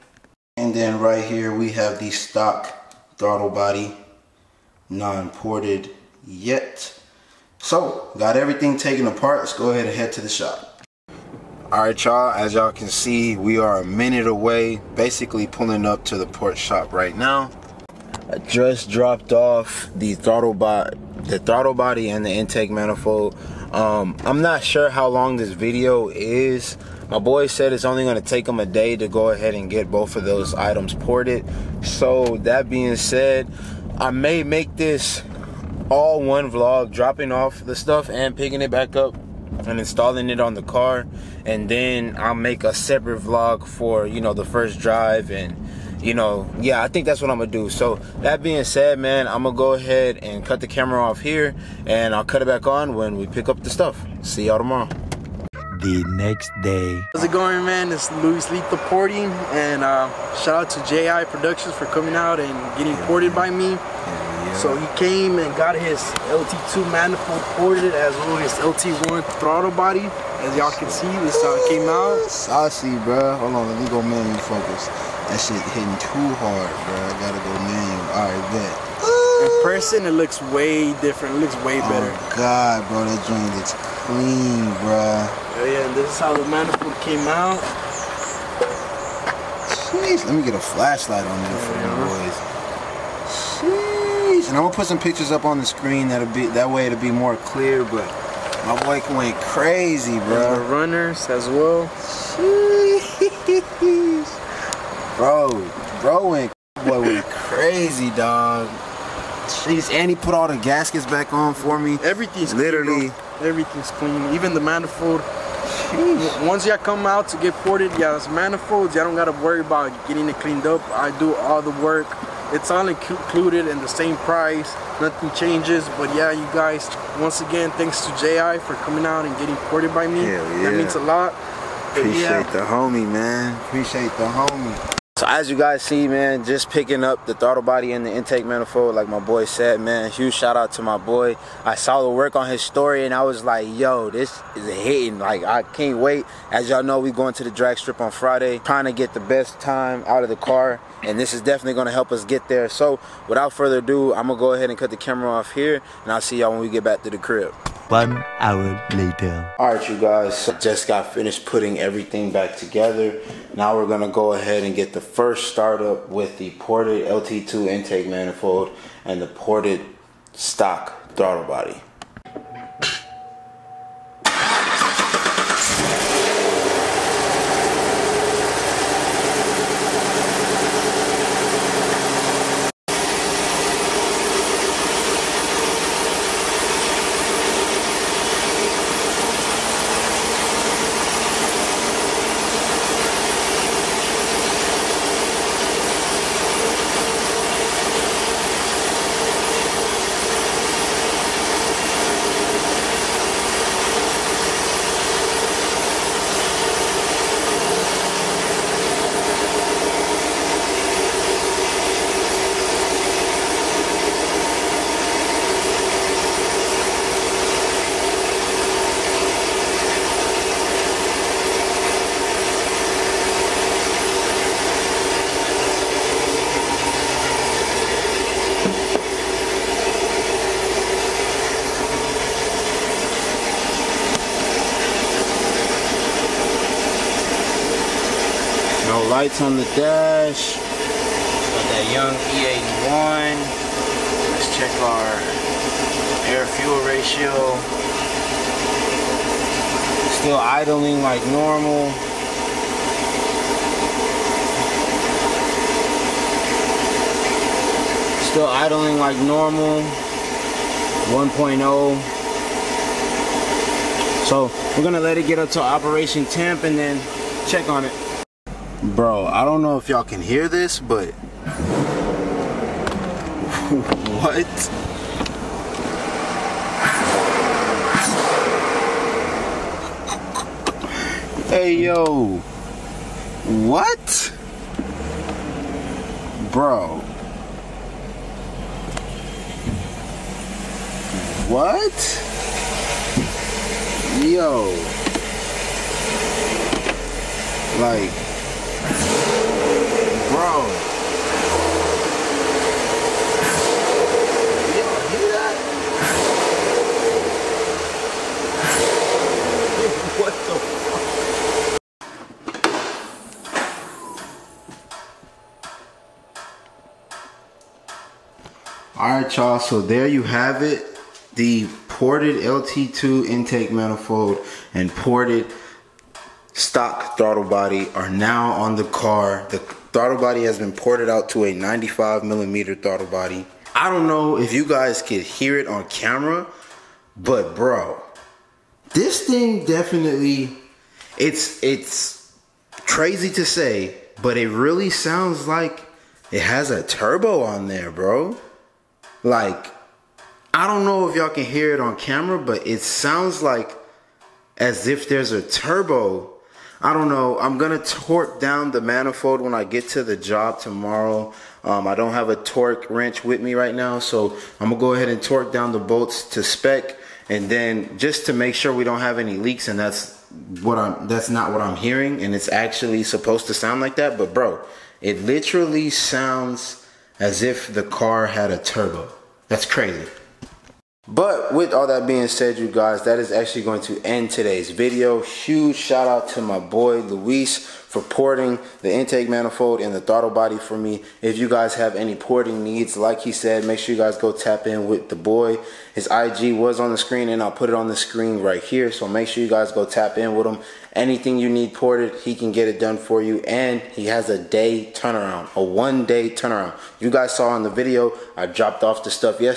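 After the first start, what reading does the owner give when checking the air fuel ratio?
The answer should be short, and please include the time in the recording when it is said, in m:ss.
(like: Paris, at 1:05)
1.0, at 4:21.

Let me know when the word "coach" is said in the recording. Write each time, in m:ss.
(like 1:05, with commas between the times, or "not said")
not said.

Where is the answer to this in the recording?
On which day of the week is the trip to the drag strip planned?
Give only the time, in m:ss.
2:28.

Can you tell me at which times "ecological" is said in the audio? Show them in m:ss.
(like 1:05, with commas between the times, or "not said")
not said.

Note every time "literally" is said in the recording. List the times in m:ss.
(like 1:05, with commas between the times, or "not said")
1:52, 6:15.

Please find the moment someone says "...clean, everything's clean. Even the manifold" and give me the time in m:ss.
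1:53.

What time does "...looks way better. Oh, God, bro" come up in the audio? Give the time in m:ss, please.
1:21.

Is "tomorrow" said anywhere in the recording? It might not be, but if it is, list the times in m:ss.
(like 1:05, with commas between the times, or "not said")
0:54, 6:00.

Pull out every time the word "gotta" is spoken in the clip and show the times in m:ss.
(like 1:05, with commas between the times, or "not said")
1:17, 1:59.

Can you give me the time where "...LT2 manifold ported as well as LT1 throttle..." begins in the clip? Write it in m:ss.
1:06.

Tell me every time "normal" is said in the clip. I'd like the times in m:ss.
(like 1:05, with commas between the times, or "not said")
4:11, 4:19.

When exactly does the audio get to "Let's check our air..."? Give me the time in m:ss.
4:04.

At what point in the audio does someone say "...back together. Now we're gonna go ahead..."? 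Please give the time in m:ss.
2:42.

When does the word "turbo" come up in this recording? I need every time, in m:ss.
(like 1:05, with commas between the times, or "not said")
5:46, 5:55, 6:18.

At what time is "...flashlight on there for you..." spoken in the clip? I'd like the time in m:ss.
1:30.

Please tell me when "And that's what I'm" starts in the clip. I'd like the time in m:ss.
6:09.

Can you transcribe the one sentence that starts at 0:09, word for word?
Let's go ahead and head to the shop.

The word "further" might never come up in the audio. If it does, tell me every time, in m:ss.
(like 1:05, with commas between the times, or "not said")
2:33.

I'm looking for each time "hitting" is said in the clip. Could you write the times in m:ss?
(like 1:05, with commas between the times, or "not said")
1:15, 2:24.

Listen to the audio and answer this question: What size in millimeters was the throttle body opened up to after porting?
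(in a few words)
95 millimeters.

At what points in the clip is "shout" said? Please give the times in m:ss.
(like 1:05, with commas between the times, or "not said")
1:00, 2:20, 6:25.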